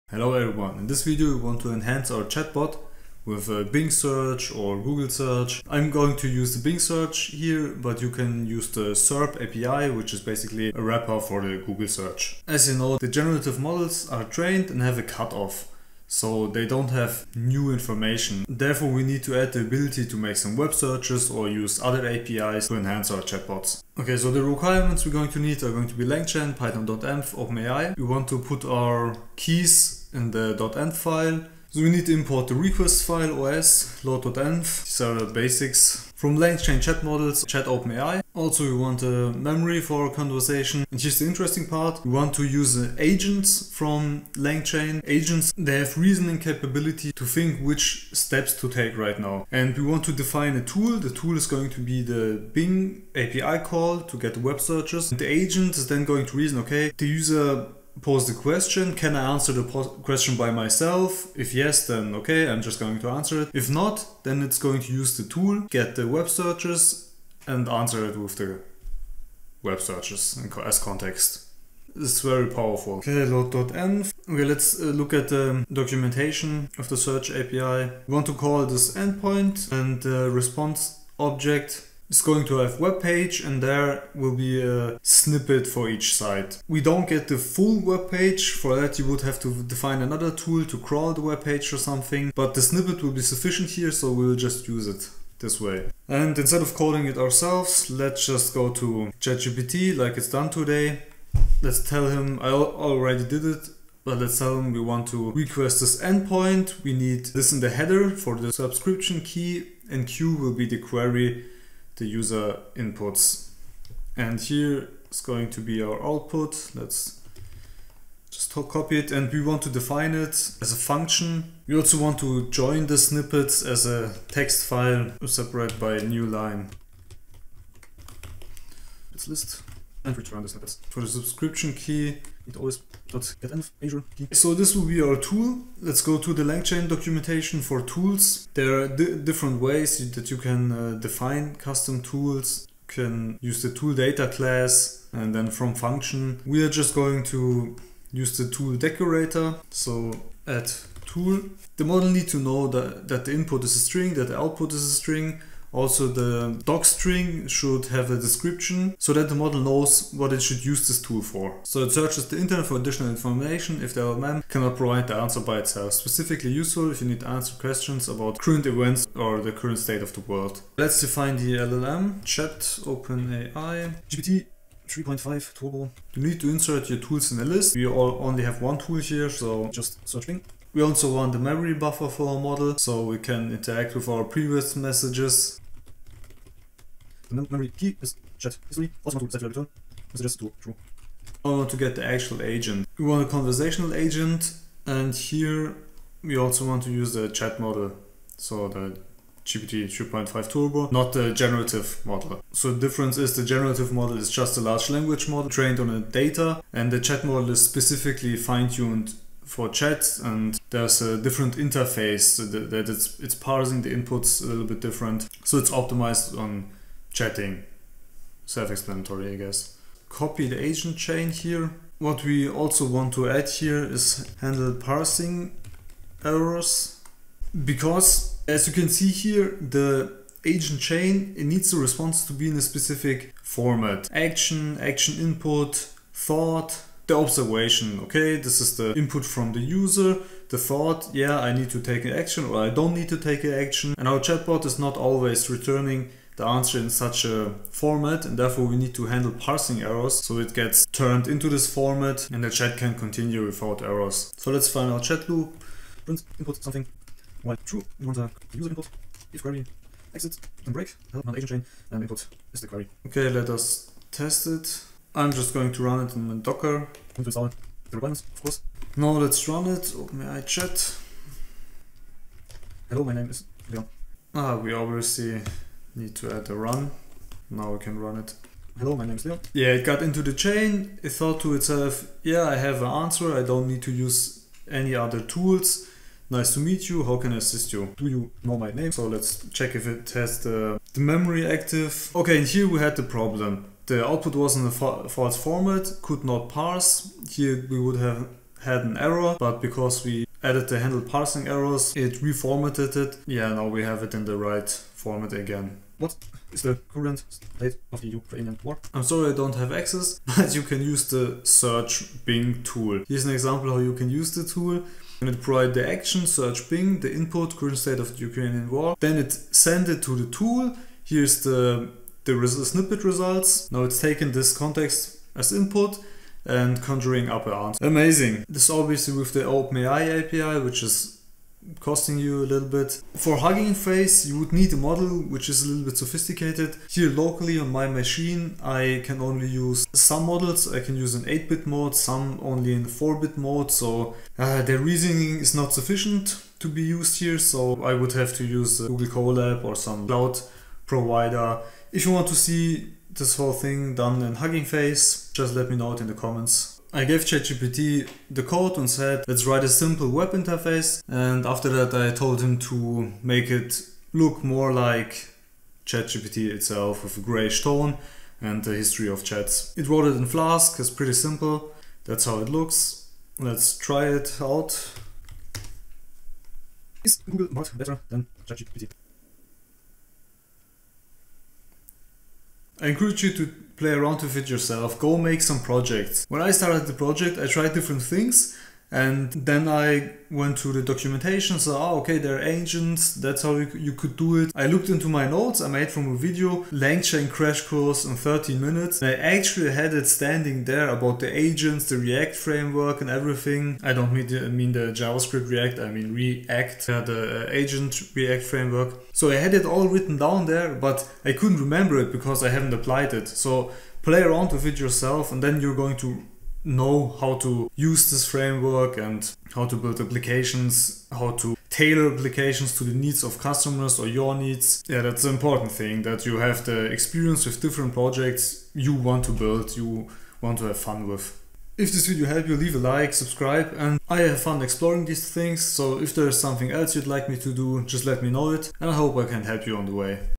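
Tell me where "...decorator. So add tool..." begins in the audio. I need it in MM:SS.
02:28.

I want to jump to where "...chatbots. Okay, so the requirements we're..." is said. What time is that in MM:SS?
00:23.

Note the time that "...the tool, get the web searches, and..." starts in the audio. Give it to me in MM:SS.
01:05.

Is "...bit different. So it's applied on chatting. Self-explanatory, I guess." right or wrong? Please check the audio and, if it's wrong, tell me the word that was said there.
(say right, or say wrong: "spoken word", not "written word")
wrong: "optimized", not "applied".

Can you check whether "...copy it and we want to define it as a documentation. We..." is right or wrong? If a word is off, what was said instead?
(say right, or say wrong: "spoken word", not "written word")
wrong: "function", not "documentation".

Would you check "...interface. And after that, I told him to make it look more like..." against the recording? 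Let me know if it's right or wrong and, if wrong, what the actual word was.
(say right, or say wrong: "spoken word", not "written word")
right.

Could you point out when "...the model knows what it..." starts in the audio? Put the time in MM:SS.
02:39.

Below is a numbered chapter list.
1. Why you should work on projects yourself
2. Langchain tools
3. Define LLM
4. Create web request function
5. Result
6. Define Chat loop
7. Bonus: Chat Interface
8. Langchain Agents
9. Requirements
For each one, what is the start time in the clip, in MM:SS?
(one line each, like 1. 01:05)
1. 06:22
2. 02:14
3. 02:59
4. 01:14
5. 04:37
6. 04:14
7. 05:57
8. 03:11
9. 00:23.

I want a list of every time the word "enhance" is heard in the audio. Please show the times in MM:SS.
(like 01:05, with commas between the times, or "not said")
00:01, 00:22.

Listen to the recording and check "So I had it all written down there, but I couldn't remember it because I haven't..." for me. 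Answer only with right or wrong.
right.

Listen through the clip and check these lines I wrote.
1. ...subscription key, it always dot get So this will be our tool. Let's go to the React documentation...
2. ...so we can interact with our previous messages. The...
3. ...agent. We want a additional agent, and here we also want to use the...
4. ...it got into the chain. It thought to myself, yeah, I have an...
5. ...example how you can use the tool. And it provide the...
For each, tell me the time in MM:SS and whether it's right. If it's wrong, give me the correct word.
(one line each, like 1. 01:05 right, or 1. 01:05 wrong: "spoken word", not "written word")
1. 02:11 wrong: "LangChain", not "React"
2. 03:02 right
3. 03:12 wrong: "conversational", not "additional"
4. 04:39 wrong: "itself", not "myself"
5. 05:13 right.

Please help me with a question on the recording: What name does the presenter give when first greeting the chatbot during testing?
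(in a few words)
Leon.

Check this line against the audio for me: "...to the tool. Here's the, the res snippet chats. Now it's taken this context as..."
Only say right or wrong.
wrong.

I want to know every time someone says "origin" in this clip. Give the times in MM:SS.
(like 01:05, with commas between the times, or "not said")
not said.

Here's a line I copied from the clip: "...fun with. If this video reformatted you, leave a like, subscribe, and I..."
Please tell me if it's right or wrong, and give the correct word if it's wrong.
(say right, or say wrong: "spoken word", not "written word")
wrong: "helped", not "reformatted".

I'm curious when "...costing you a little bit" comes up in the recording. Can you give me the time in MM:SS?
05:31.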